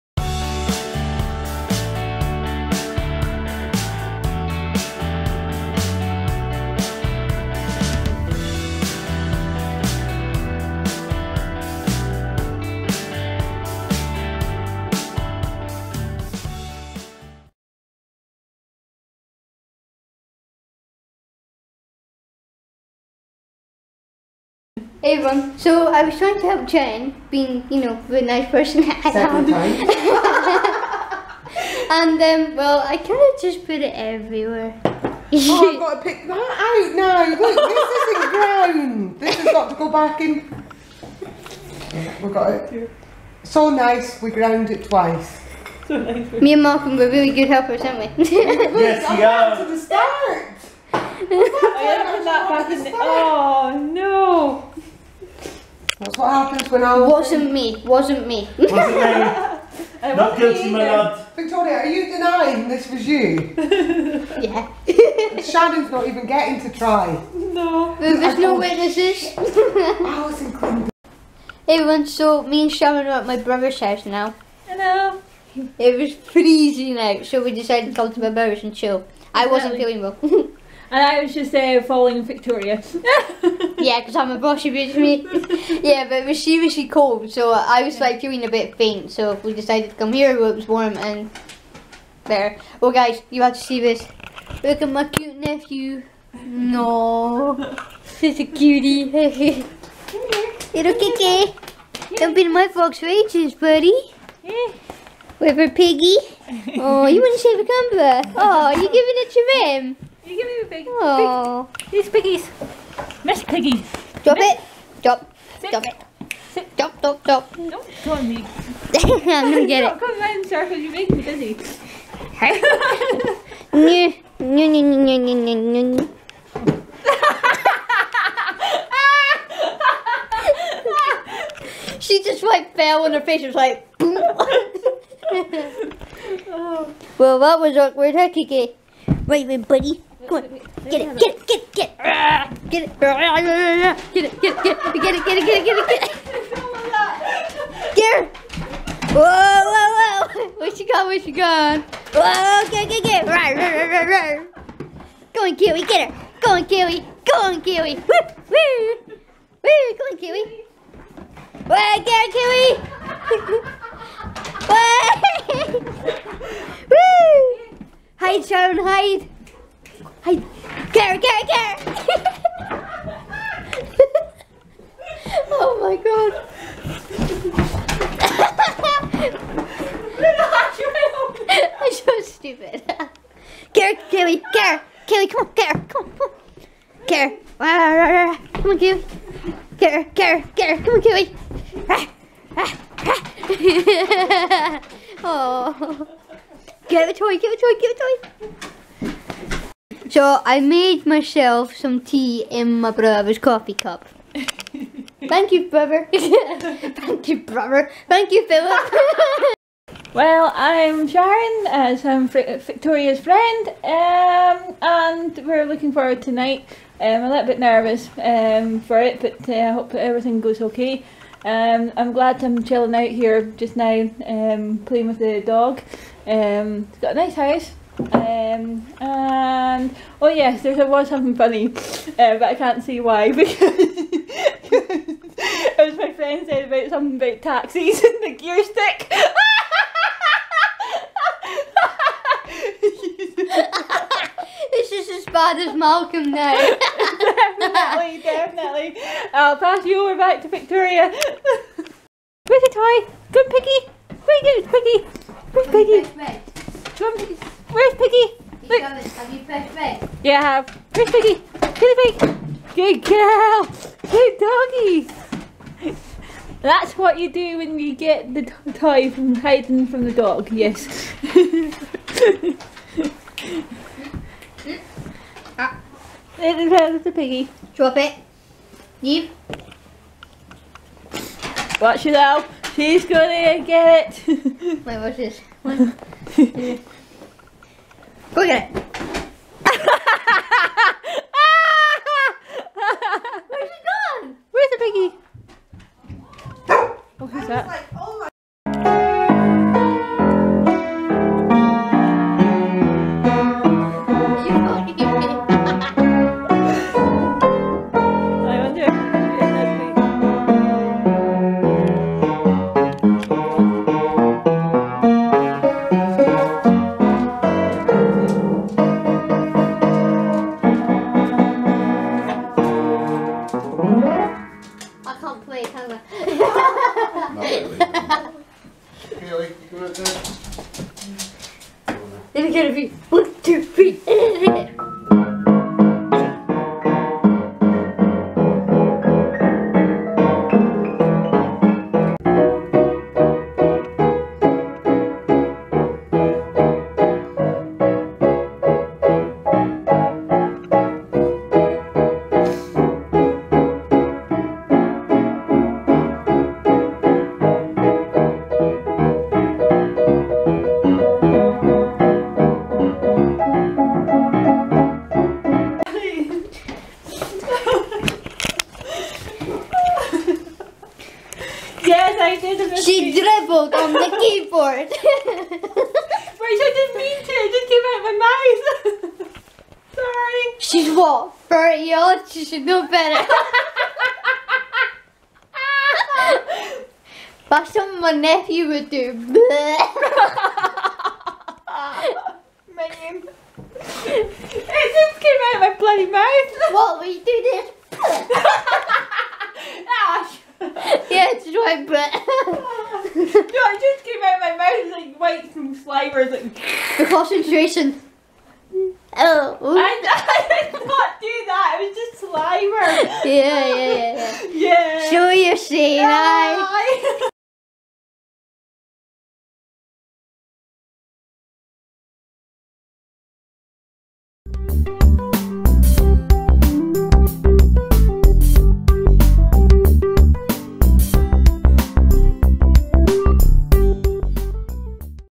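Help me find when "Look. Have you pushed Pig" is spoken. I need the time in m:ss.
4:18.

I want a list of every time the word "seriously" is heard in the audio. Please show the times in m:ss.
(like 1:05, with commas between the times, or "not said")
1:26.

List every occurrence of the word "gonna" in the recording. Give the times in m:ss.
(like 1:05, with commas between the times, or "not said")
1:59, 4:43.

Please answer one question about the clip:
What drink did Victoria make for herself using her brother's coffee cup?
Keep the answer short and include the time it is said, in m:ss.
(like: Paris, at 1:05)
tea, at 3:22.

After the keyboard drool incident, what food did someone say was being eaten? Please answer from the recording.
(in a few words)
dry bread.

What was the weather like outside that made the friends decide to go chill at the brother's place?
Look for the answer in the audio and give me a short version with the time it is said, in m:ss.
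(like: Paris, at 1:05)
freezing, at 1:16.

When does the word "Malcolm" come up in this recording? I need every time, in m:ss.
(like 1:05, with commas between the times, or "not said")
0:46, 4:05.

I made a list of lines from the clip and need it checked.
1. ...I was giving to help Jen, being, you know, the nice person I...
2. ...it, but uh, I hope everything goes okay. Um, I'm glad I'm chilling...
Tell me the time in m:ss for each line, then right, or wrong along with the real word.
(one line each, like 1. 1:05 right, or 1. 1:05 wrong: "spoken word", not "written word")
1. 0:25 wrong: "trying", not "giving"
2. 3:38 right.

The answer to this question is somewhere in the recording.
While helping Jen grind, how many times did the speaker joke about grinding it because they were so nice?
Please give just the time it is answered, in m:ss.
0:44.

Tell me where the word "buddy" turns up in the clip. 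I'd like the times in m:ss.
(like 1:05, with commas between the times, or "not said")
1:43, 2:19.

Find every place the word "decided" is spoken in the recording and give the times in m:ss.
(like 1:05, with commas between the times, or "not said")
1:17, 1:29.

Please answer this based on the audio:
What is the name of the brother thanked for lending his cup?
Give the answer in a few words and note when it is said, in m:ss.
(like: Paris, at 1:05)
Philip, at 3:28.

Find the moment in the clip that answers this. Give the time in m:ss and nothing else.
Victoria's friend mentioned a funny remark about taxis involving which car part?
3:58.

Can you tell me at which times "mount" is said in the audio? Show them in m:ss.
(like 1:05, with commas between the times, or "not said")
not said.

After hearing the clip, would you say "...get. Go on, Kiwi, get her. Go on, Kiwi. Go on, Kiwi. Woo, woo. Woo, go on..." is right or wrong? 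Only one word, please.
right.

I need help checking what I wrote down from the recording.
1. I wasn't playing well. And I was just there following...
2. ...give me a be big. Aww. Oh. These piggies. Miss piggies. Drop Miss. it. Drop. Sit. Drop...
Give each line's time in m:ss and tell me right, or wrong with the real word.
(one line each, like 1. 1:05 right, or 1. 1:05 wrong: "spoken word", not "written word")
1. 1:19 wrong: "feeling", not "playing"
2. 1:50 right.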